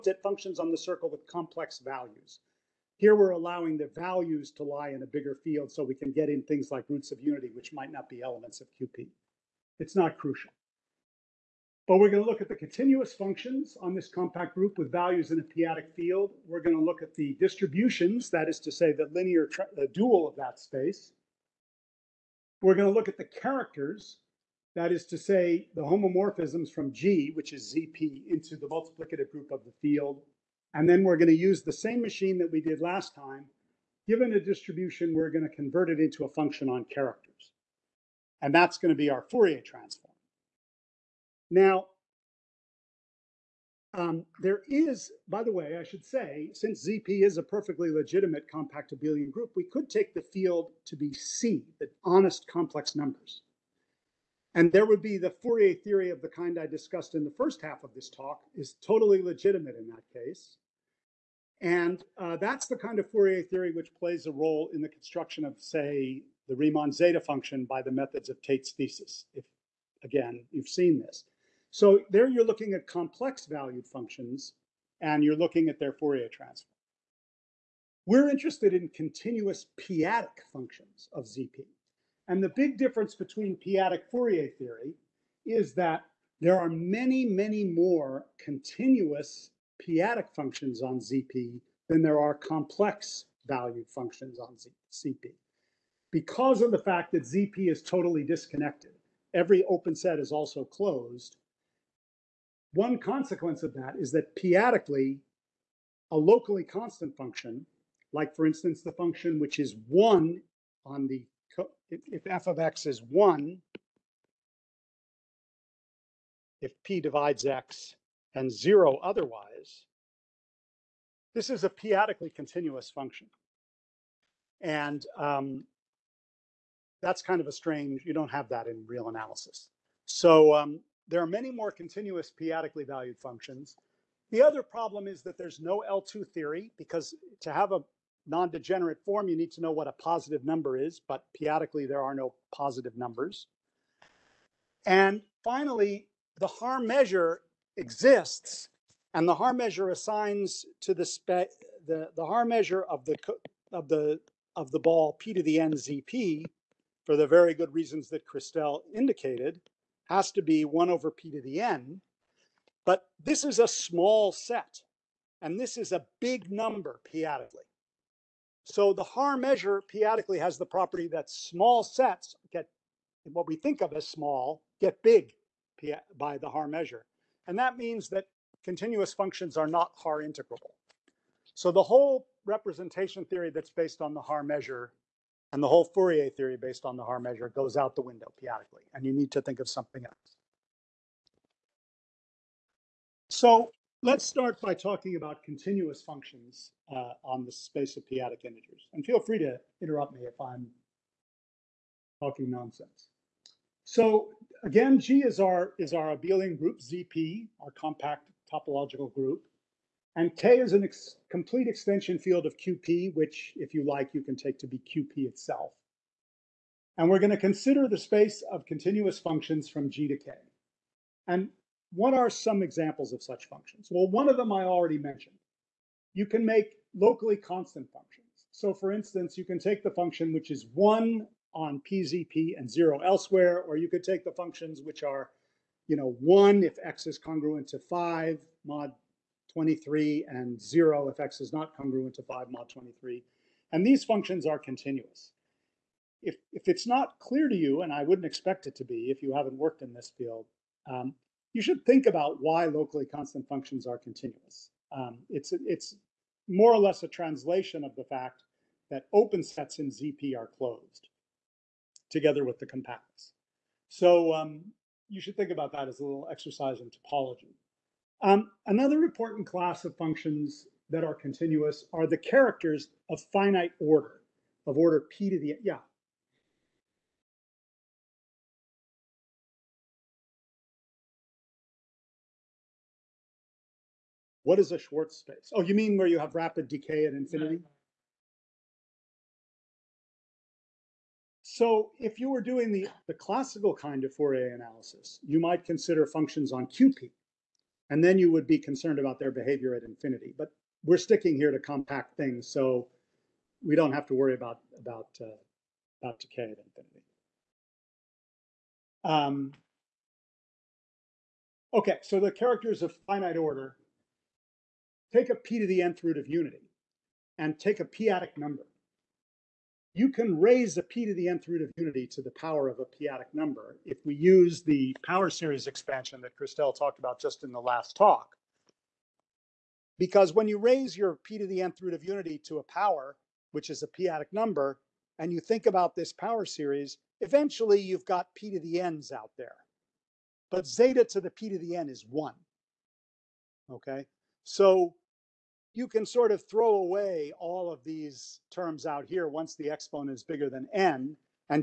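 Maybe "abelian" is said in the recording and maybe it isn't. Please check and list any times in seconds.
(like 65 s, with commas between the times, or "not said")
48 s, 206 s.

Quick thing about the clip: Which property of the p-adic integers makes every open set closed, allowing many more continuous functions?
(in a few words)
totally disconnected.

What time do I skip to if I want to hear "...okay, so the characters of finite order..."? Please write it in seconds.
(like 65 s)
311 s.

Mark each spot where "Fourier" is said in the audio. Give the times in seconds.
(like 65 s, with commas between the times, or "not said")
39 s, 55 s, 63 s, 75 s, 84 s, 185 s, 294 s.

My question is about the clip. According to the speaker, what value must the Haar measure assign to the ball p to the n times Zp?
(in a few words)
1 over p to the n.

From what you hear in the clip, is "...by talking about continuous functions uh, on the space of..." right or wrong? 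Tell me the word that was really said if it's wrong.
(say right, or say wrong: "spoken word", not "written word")
right.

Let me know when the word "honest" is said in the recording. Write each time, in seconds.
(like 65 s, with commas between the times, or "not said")
52 s.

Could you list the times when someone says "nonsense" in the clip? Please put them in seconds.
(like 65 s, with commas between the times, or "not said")
202 s.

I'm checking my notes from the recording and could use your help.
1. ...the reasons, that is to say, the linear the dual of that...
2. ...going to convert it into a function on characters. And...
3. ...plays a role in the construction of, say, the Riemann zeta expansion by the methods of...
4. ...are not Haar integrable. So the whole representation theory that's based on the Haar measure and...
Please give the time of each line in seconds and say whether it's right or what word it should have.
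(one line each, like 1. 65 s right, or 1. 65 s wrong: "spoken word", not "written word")
1. 17 s wrong: "distributions", not "reasons"
2. 35 s right
3. 63 s wrong: "function", not "expansion"
4. 179 s right.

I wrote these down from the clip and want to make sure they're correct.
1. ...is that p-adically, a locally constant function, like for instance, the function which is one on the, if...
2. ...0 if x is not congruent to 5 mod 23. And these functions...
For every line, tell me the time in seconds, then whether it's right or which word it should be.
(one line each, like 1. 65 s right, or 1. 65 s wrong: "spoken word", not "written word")
1. 103 s right
2. 240 s right.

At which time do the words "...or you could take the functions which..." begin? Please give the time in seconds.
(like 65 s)
233 s.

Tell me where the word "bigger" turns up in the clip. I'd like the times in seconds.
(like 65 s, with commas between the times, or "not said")
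5 s, 350 s.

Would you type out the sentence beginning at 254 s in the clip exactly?
Um, it's, it's more or less a translation of the fact that open sets in ZP are closed together with the compacts.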